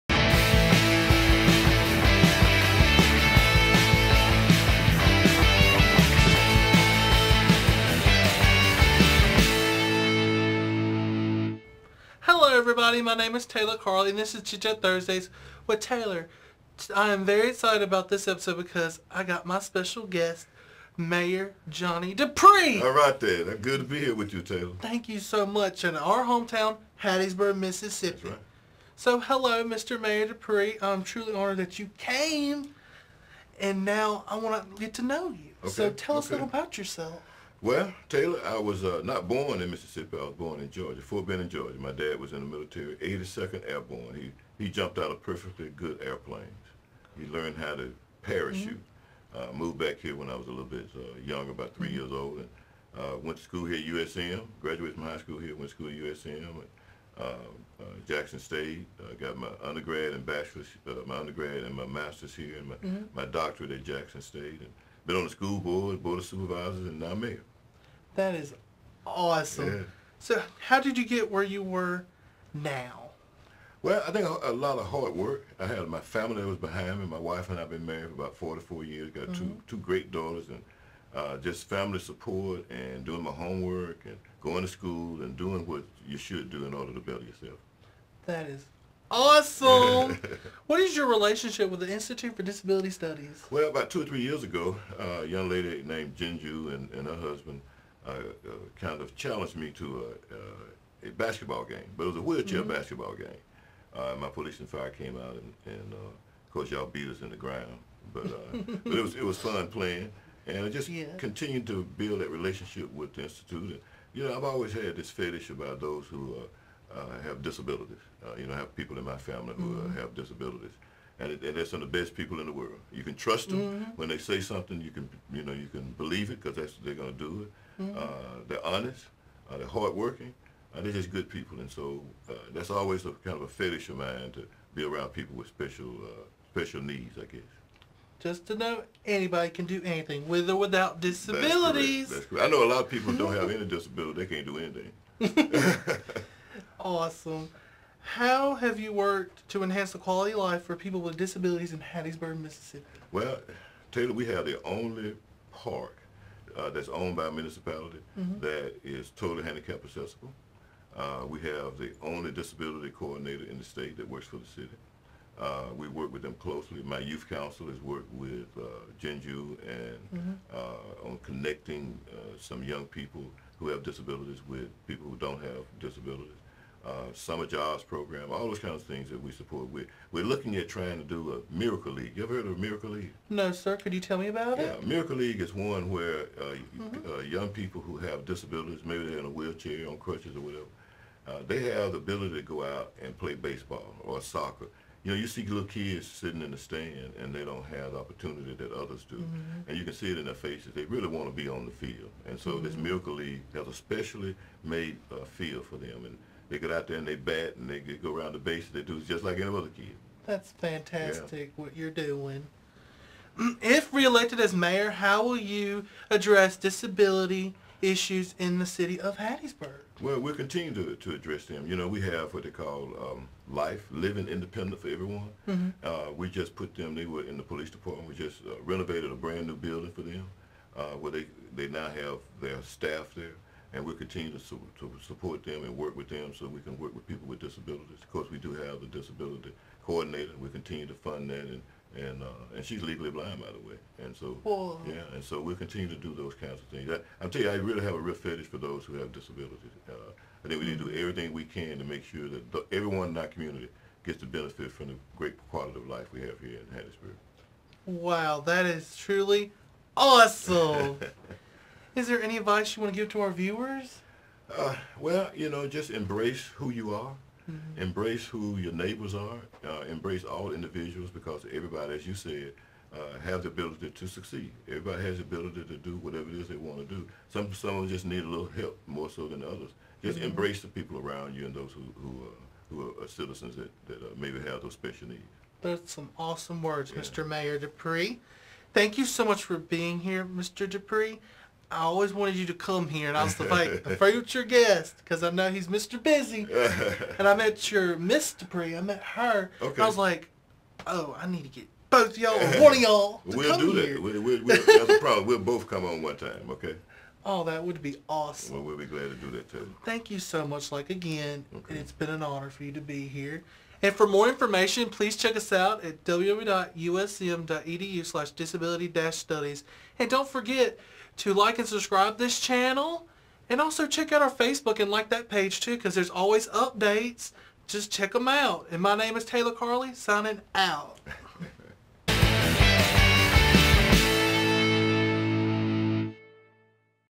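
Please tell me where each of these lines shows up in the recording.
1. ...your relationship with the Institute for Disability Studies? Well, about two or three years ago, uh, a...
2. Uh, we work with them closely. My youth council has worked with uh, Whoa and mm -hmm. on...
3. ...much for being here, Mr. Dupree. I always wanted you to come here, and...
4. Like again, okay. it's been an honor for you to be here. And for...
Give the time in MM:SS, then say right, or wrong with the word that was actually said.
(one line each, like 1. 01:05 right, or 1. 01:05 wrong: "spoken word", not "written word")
1. 01:30 right
2. 02:45 wrong: "Jinju", not "Whoa"
3. 04:49 right
4. 05:10 right.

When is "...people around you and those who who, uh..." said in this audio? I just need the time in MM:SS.
04:40.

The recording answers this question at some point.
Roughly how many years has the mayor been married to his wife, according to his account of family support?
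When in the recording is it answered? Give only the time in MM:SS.
01:18.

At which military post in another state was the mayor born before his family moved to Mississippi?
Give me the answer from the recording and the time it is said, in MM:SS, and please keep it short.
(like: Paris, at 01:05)
Fort Benning, at 00:40.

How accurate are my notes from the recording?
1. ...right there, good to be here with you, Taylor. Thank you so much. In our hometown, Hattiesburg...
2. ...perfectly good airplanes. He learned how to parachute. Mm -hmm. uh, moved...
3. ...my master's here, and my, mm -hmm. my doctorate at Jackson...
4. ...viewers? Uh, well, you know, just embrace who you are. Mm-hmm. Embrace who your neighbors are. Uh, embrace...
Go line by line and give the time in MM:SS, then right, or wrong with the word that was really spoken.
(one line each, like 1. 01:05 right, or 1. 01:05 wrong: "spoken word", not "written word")
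1. 00:22 right
2. 00:45 right
3. 01:01 right
4. 04:23 right.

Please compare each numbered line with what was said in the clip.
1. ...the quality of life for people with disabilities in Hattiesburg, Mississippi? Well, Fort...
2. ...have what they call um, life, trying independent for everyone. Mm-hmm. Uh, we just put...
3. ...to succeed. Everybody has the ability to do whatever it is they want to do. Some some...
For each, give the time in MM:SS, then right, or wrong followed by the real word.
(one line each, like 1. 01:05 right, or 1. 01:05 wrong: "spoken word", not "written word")
1. 02:29 wrong: "Taylor", not "Fort"
2. 03:42 wrong: "living", not "trying"
3. 04:33 right.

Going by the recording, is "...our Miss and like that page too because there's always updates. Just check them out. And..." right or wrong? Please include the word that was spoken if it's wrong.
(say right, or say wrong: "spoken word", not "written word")
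wrong: "Facebook", not "Miss".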